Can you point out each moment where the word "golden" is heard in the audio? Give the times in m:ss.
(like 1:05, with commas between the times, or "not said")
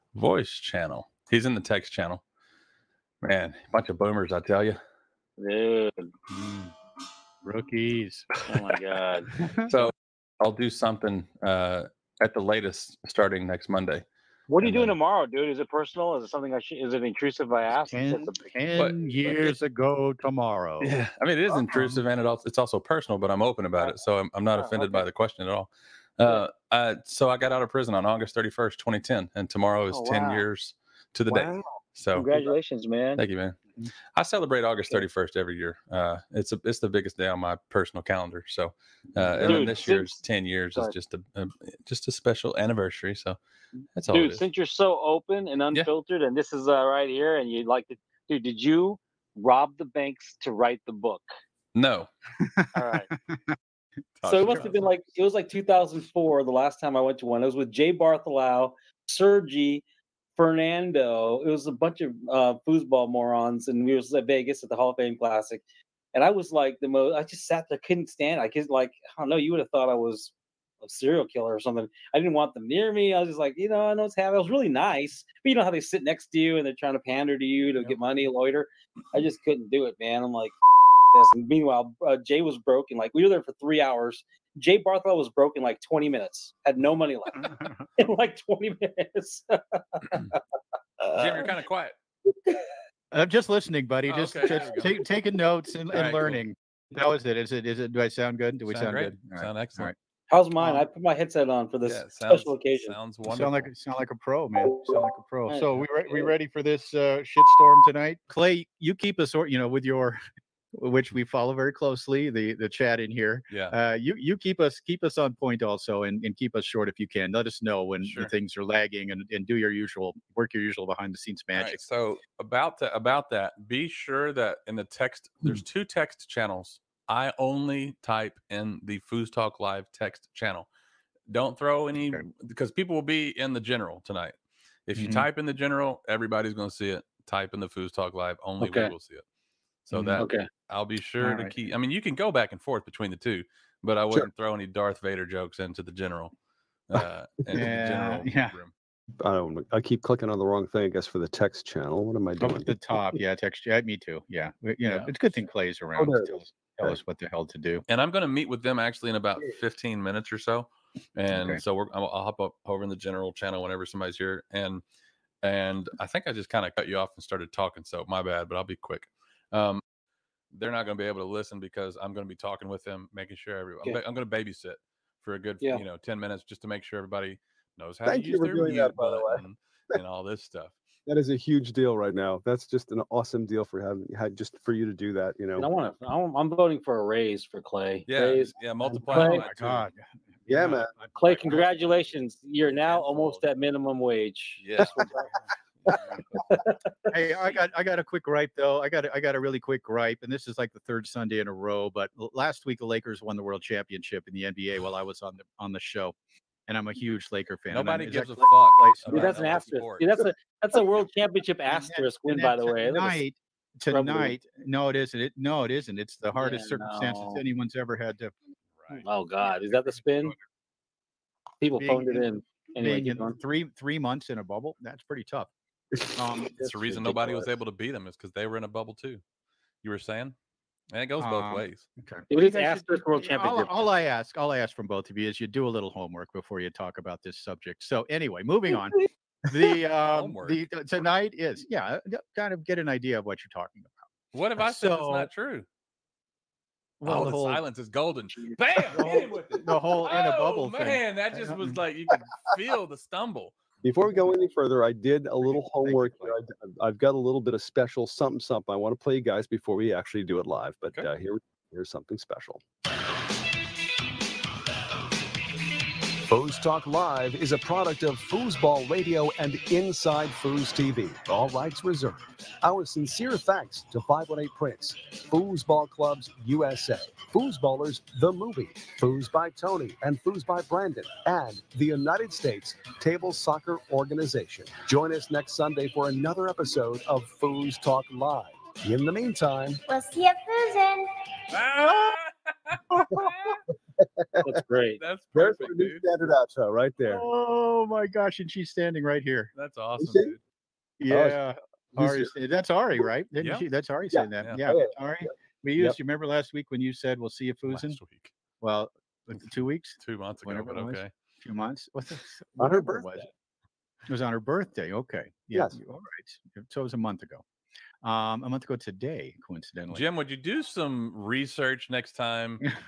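4:07.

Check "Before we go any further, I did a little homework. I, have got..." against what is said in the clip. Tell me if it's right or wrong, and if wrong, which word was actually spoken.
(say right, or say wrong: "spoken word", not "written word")
right.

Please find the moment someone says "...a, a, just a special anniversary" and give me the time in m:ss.
0:41.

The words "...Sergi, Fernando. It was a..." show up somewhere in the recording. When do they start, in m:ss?
0:59.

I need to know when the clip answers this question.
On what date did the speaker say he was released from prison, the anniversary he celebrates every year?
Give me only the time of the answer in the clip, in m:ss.
0:28.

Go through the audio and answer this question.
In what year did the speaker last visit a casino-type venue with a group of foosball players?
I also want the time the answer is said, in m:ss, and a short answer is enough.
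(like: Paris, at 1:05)
2004, at 0:55.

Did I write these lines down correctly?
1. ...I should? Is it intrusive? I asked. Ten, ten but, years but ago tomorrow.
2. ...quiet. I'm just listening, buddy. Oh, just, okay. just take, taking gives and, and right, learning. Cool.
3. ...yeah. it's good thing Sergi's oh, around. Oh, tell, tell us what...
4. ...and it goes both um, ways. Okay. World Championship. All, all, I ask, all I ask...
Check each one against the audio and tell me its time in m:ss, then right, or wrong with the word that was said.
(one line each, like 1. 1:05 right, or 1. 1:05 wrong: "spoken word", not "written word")
1. 0:16 right
2. 1:31 wrong: "notes", not "gives"
3. 2:34 wrong: "Clay", not "Sergi"
4. 3:50 right.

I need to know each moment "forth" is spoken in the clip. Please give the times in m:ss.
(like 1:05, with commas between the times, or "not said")
2:22.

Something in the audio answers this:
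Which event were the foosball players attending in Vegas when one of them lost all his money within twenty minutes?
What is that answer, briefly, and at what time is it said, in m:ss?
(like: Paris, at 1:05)
Hall of Fame Classic, at 1:04.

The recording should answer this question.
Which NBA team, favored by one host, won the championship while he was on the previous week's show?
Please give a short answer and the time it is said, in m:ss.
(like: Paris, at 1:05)
Lakers, at 3:22.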